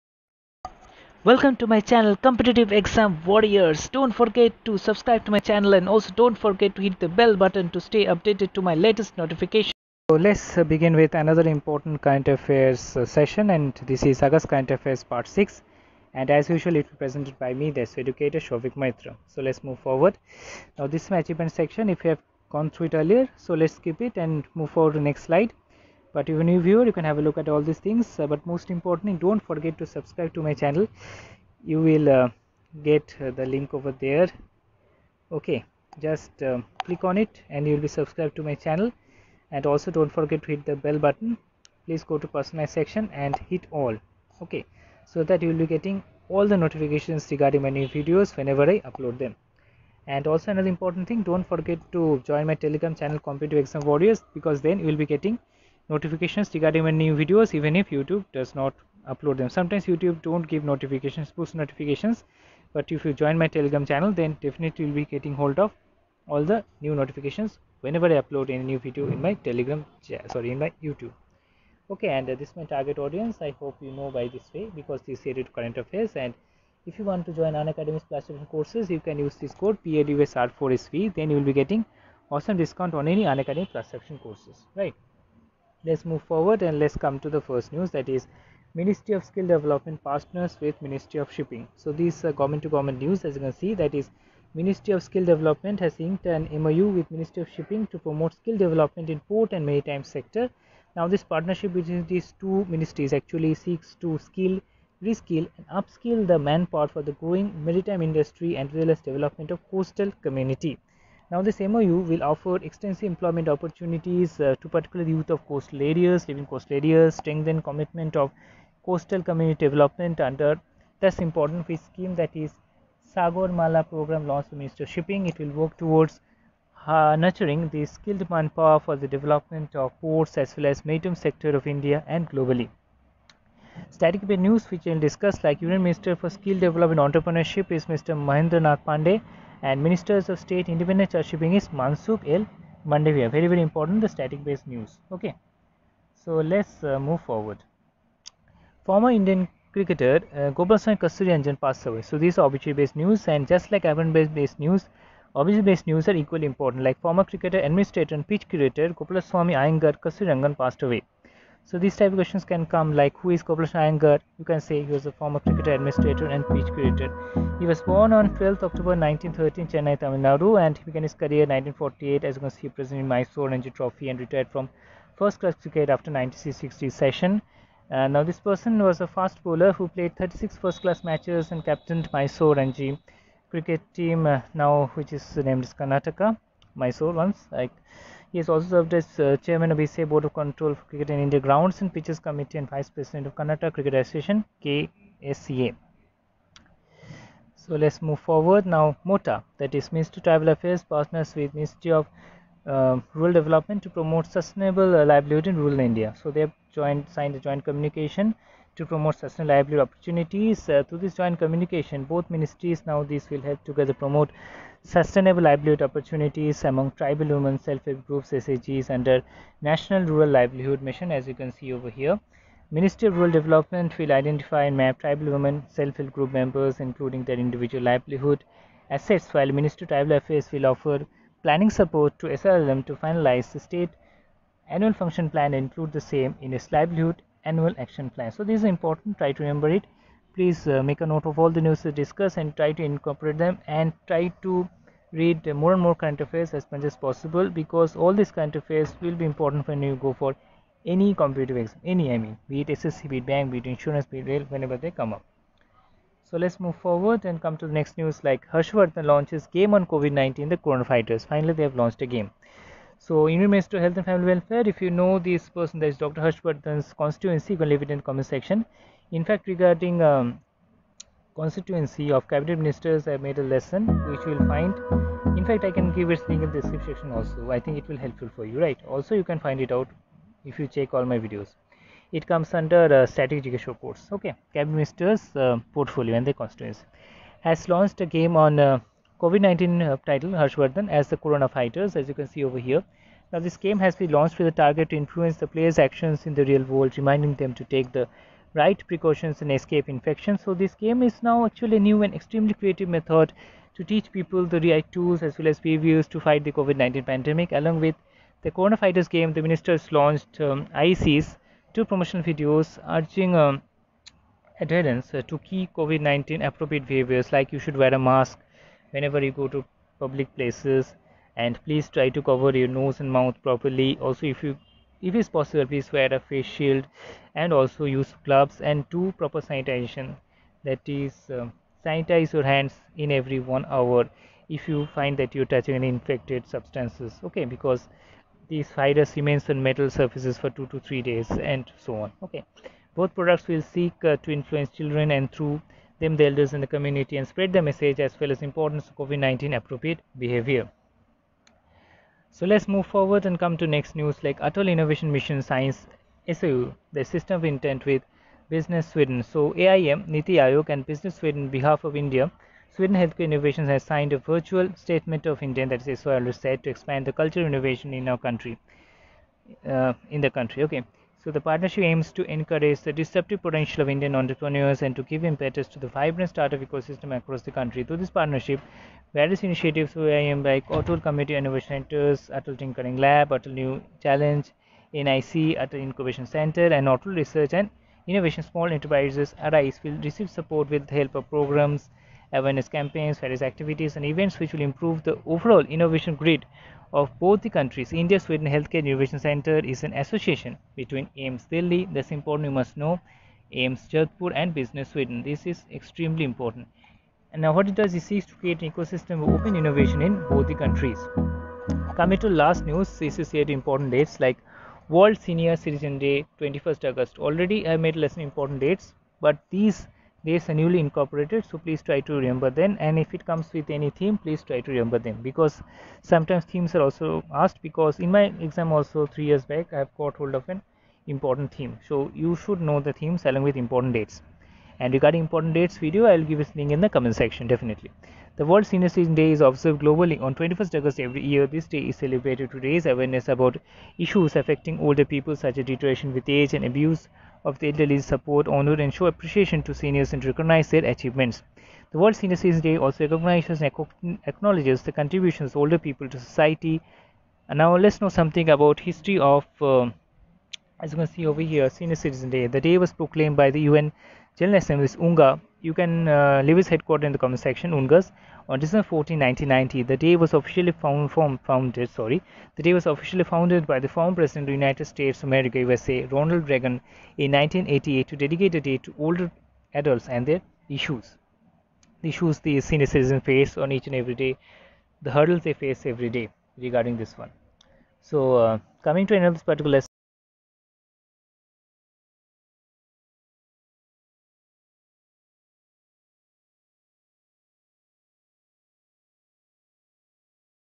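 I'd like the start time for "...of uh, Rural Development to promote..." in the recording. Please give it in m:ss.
3:21.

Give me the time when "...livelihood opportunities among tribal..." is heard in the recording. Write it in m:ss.
3:35.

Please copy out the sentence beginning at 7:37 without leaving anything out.
And now let's know something about history of, uh, as you can see over here, Senior Citizen Day.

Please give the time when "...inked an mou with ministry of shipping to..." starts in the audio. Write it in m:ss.
1:35.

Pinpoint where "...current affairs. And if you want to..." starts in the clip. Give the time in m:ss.
1:15.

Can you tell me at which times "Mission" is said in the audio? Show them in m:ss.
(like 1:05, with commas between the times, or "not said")
3:40, 5:55.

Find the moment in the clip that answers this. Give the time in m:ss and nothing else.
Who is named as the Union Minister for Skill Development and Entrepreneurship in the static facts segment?
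2:18.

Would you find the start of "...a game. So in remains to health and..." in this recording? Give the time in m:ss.
4:22.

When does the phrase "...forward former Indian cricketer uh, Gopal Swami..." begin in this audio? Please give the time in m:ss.
2:27.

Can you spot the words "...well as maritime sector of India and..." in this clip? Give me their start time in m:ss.
2:10.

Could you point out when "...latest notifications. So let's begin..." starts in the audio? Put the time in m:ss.
0:08.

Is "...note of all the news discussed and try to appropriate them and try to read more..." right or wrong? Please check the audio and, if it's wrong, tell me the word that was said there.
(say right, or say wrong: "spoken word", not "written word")
wrong: "incorporate", not "appropriate".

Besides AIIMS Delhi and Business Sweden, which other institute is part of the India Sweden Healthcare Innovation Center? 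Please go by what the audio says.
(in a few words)
AIIMS Jodhpur.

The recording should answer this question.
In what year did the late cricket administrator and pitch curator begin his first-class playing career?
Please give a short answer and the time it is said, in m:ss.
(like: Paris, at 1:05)
1948, at 2:51.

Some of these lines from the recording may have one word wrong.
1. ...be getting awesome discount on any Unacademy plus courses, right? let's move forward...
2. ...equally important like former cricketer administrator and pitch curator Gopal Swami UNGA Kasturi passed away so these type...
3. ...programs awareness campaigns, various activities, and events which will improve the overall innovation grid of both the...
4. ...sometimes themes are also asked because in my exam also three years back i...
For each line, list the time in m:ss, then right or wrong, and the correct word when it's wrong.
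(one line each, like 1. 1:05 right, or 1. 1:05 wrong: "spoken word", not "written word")
1. 1:21 right
2. 2:36 wrong: "Iyengar", not "UNGA"
3. 6:31 right
4. 7:06 right.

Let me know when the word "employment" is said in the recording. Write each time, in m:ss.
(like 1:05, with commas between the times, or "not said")
1:53.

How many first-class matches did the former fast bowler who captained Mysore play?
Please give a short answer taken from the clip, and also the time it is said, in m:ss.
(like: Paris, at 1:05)
36, at 3:00.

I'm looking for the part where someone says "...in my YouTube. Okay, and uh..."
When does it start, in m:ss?
1:10.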